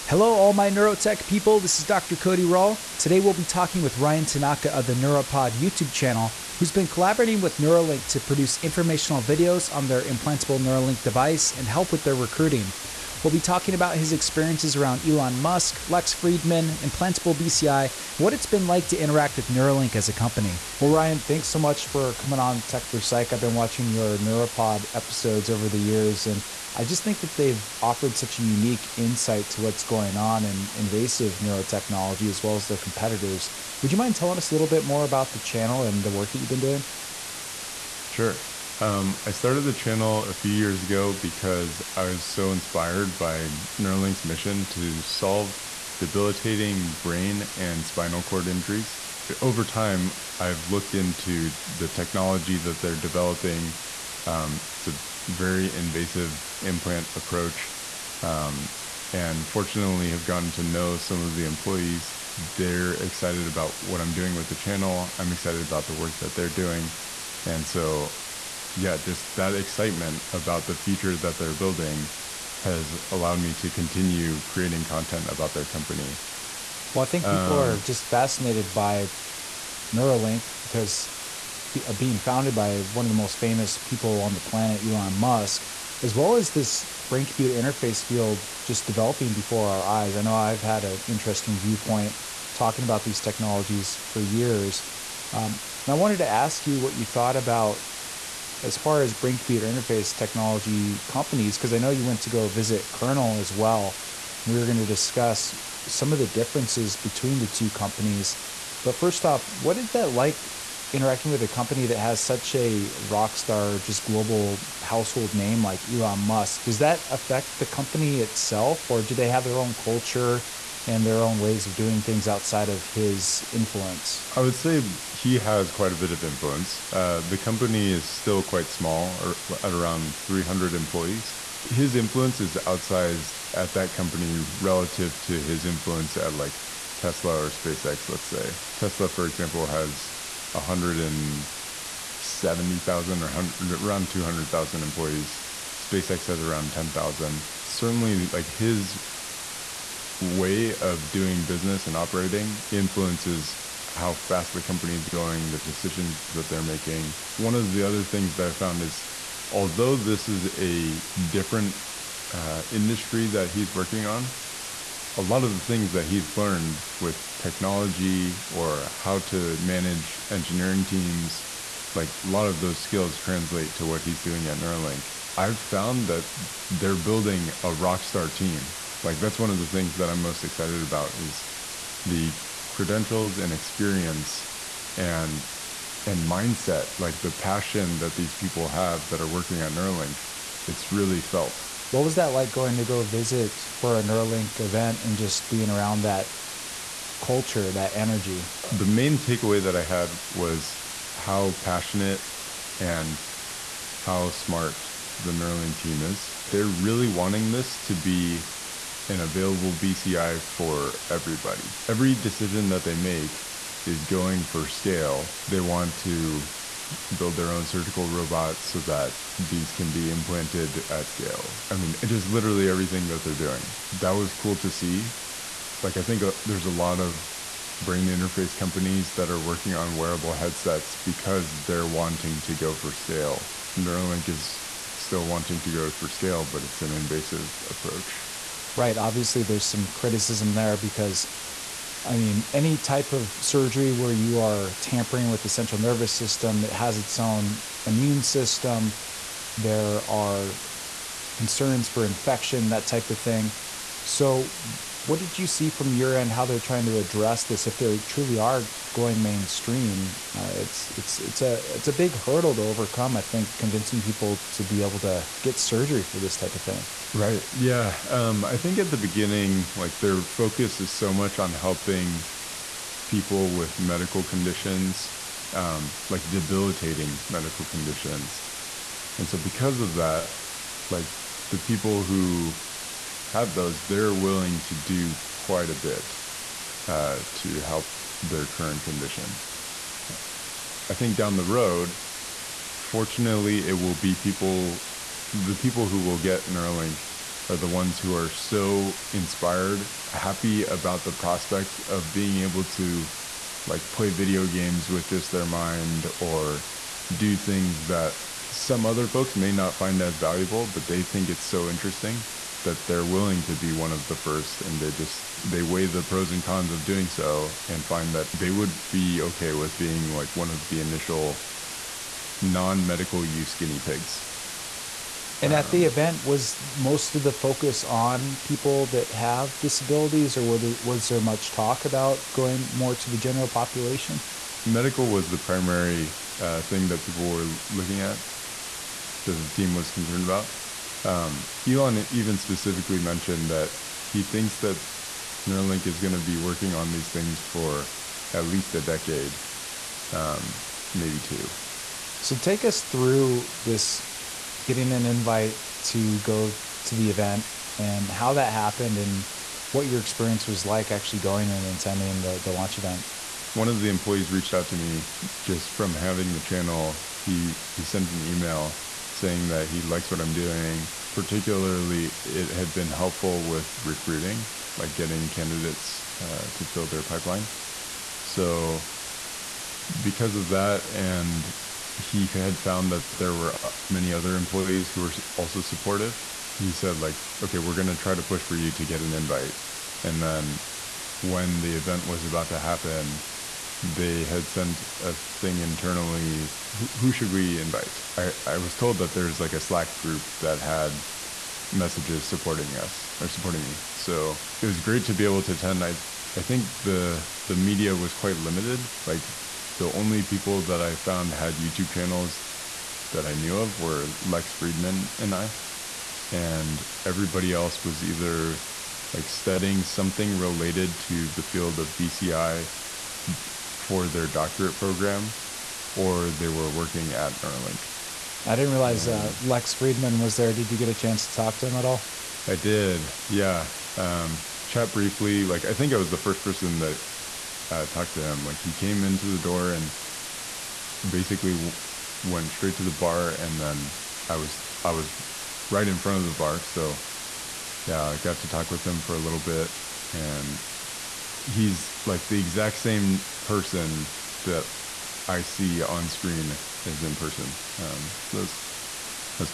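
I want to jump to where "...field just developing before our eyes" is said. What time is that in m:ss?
1:28.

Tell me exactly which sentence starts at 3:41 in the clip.
I mean, just literally everything that they're doing.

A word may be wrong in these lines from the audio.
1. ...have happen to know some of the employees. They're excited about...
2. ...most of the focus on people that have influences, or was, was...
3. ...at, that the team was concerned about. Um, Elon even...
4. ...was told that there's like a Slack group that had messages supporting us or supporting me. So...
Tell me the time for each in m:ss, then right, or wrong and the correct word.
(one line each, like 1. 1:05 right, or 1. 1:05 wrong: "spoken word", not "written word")
1. 1:00 wrong: "gotten", not "happen"
2. 5:26 wrong: "disabilities", not "influences"
3. 5:38 right
4. 6:38 right.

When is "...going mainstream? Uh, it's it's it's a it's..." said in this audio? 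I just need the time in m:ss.
4:18.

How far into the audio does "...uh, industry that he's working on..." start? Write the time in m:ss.
2:42.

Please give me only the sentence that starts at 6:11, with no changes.
Particularly, it had been helpful with recruiting, like getting candidates uh, to fill their pipeline.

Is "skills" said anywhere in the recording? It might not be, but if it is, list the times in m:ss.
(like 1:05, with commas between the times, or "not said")
2:52.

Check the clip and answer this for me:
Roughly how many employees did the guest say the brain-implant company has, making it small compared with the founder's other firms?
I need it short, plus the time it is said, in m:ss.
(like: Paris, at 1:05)
300, at 2:10.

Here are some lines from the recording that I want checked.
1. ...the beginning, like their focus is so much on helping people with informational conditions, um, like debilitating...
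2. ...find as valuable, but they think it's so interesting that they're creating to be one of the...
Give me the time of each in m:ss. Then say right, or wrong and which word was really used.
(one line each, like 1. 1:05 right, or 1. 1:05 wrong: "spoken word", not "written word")
1. 4:28 wrong: "medical", not "informational"
2. 5:09 wrong: "willing", not "creating".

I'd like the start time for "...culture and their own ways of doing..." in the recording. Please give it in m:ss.
1:59.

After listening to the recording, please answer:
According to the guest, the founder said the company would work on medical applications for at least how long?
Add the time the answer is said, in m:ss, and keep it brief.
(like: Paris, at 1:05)
a decade, at 5:48.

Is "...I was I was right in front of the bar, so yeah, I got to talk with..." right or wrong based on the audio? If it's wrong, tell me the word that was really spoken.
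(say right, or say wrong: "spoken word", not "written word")
right.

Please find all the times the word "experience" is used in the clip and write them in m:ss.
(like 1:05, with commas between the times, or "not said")
0:14, 3:03, 5:59.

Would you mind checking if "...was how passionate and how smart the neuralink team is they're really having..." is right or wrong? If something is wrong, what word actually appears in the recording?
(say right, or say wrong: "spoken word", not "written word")
wrong: "wanting", not "having".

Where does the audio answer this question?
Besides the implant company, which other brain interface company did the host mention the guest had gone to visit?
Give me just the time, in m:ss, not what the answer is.
1:42.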